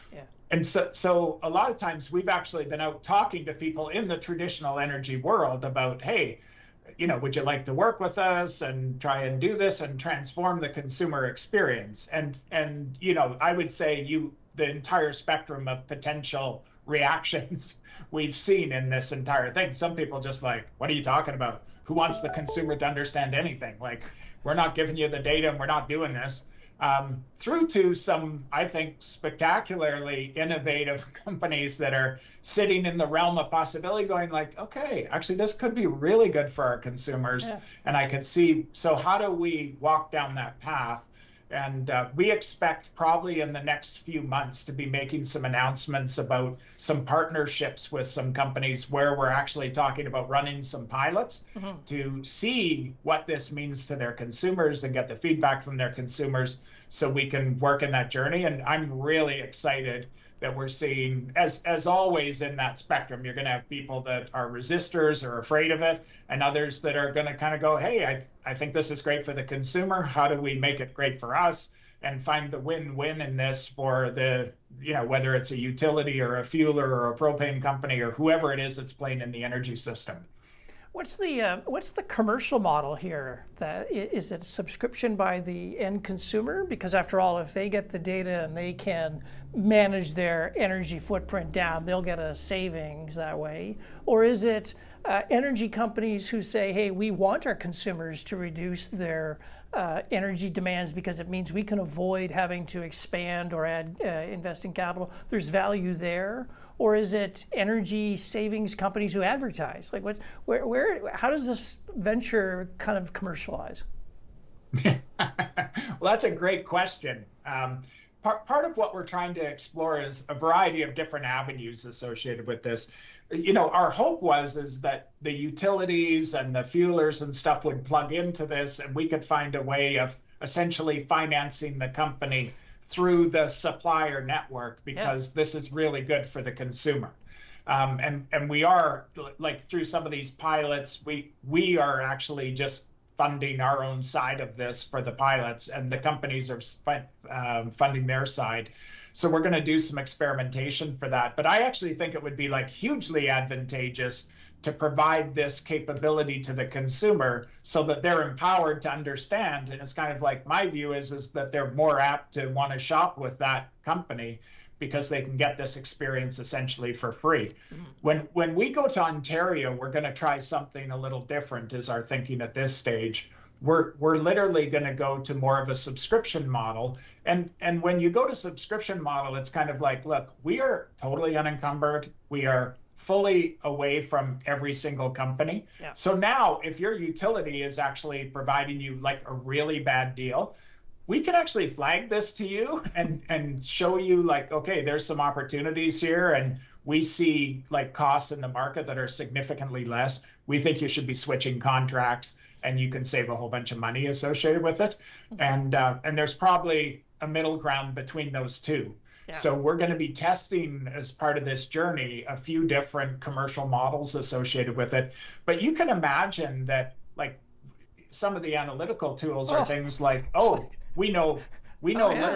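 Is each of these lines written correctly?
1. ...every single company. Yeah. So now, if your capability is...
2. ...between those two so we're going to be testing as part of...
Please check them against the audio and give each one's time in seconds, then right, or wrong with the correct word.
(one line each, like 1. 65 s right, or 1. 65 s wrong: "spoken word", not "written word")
1. 184 s wrong: "utility", not "capability"
2. 207 s right.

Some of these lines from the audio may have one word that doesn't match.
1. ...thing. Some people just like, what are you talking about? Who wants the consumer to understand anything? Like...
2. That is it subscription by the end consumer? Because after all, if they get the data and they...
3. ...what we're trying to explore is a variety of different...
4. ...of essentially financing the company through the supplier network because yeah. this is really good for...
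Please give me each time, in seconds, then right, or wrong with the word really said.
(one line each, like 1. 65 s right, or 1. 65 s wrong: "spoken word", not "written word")
1. 19 s right
2. 83 s right
3. 118 s right
4. 129 s right.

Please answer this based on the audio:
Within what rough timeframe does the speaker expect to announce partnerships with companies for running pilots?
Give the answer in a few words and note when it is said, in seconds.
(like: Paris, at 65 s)
next few months, at 43 s.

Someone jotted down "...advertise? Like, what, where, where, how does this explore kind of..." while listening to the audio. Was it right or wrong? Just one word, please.
wrong.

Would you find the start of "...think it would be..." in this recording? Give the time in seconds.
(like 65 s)
151 s.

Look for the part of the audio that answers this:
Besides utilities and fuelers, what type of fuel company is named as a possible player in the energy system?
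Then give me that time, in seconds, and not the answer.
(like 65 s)
77 s.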